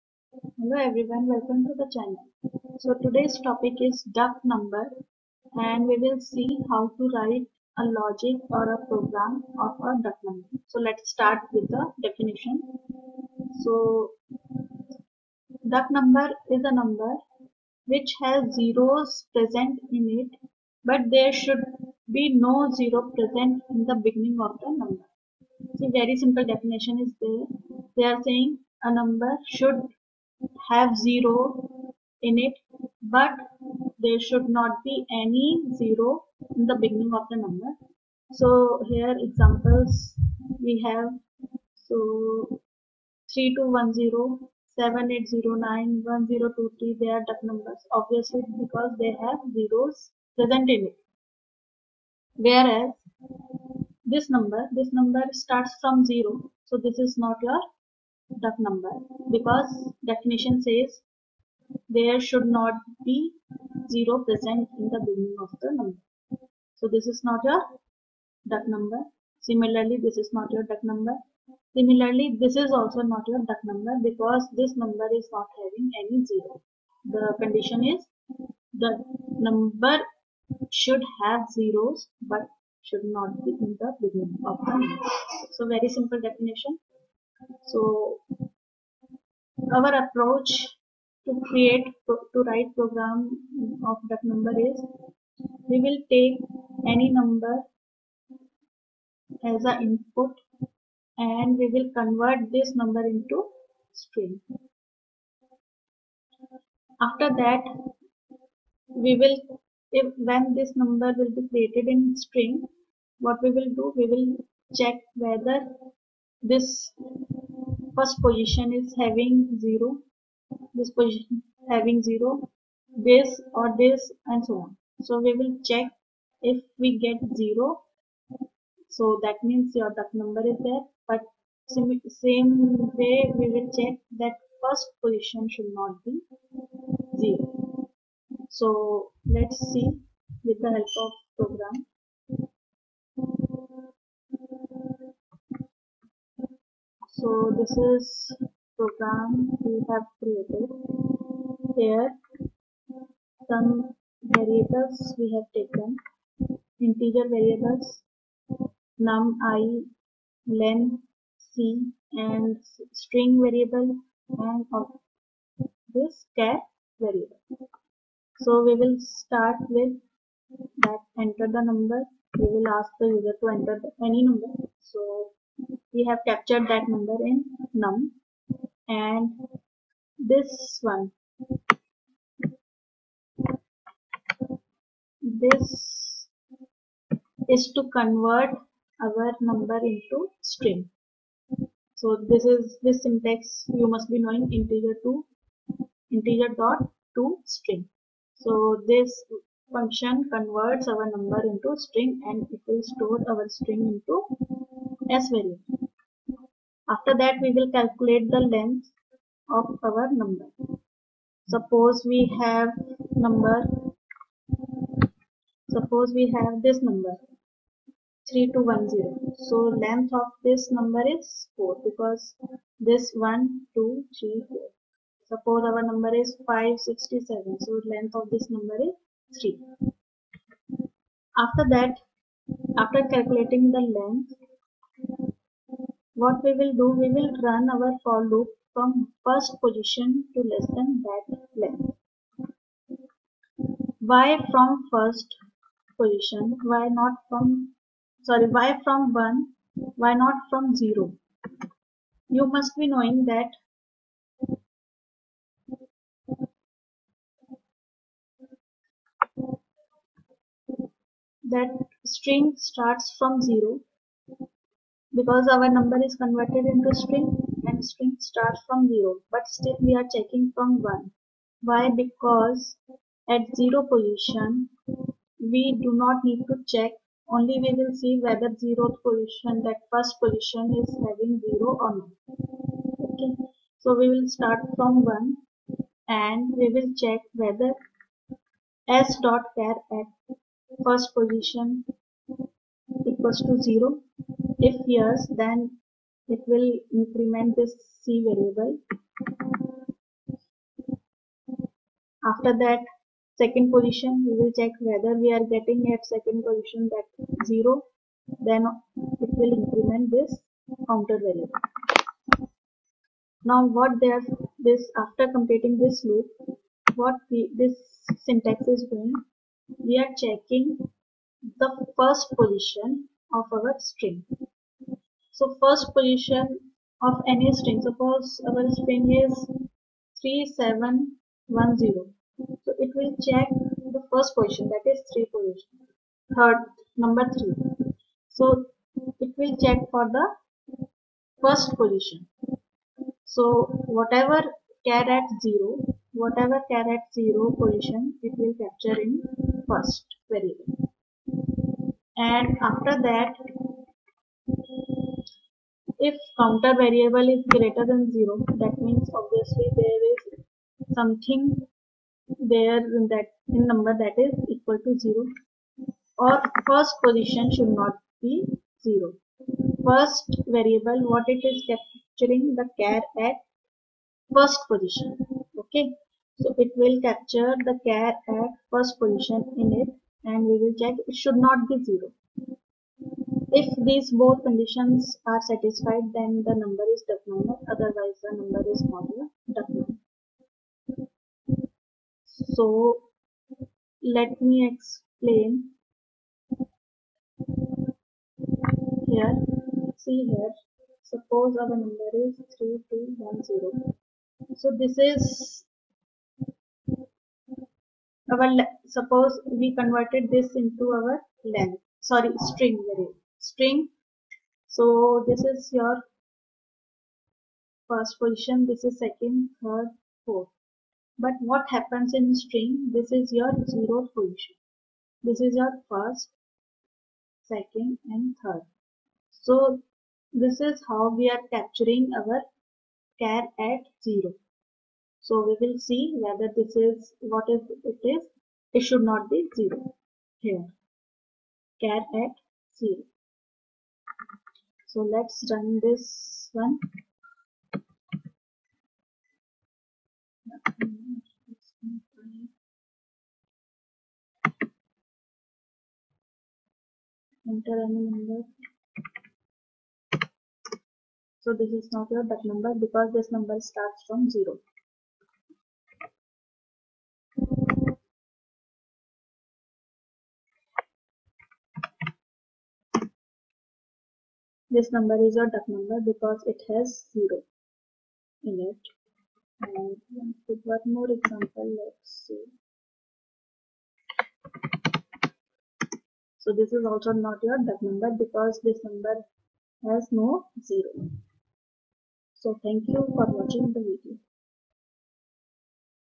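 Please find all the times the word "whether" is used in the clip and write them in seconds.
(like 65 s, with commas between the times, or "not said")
115 s, 278 s, 287 s, 304 s, 436 s.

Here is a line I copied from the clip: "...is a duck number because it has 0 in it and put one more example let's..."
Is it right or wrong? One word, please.
right.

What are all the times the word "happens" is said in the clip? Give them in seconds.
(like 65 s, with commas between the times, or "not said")
421 s.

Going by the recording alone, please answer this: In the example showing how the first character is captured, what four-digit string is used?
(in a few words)
3710.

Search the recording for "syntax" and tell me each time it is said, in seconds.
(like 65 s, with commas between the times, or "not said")
193 s, 318 s.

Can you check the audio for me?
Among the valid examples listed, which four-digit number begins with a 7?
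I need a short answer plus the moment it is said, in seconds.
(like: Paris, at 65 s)
7809, at 44 s.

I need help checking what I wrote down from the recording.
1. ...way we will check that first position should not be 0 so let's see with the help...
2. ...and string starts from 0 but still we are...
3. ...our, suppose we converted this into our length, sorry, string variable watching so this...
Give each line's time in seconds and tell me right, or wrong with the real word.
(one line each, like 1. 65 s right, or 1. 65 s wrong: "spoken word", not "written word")
1. 133 s right
2. 267 s right
3. 408 s wrong: "string", not "watching".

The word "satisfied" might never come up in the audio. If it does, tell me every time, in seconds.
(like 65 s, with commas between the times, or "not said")
385 s.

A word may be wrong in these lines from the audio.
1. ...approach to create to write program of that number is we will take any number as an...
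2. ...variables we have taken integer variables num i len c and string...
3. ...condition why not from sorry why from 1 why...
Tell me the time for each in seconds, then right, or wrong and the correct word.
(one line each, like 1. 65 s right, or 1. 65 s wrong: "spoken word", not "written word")
1. 90 s right
2. 154 s right
3. 246 s wrong: "position", not "condition".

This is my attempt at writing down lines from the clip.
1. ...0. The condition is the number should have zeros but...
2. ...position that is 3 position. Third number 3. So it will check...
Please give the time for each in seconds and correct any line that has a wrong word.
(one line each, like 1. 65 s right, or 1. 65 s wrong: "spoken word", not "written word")
1. 76 s right
2. 334 s right.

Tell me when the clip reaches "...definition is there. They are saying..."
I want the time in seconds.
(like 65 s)
26 s.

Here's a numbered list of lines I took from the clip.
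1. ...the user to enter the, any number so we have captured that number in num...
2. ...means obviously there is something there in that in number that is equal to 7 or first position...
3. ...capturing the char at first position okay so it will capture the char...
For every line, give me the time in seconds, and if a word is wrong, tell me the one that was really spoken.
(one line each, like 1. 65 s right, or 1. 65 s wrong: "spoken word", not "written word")
1. 173 s right
2. 358 s wrong: "0", not "7"
3. 371 s right.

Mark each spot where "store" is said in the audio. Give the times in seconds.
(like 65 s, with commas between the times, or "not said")
202 s.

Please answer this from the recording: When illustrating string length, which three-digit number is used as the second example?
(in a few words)
567.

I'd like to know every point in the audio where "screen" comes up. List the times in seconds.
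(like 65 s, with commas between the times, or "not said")
not said.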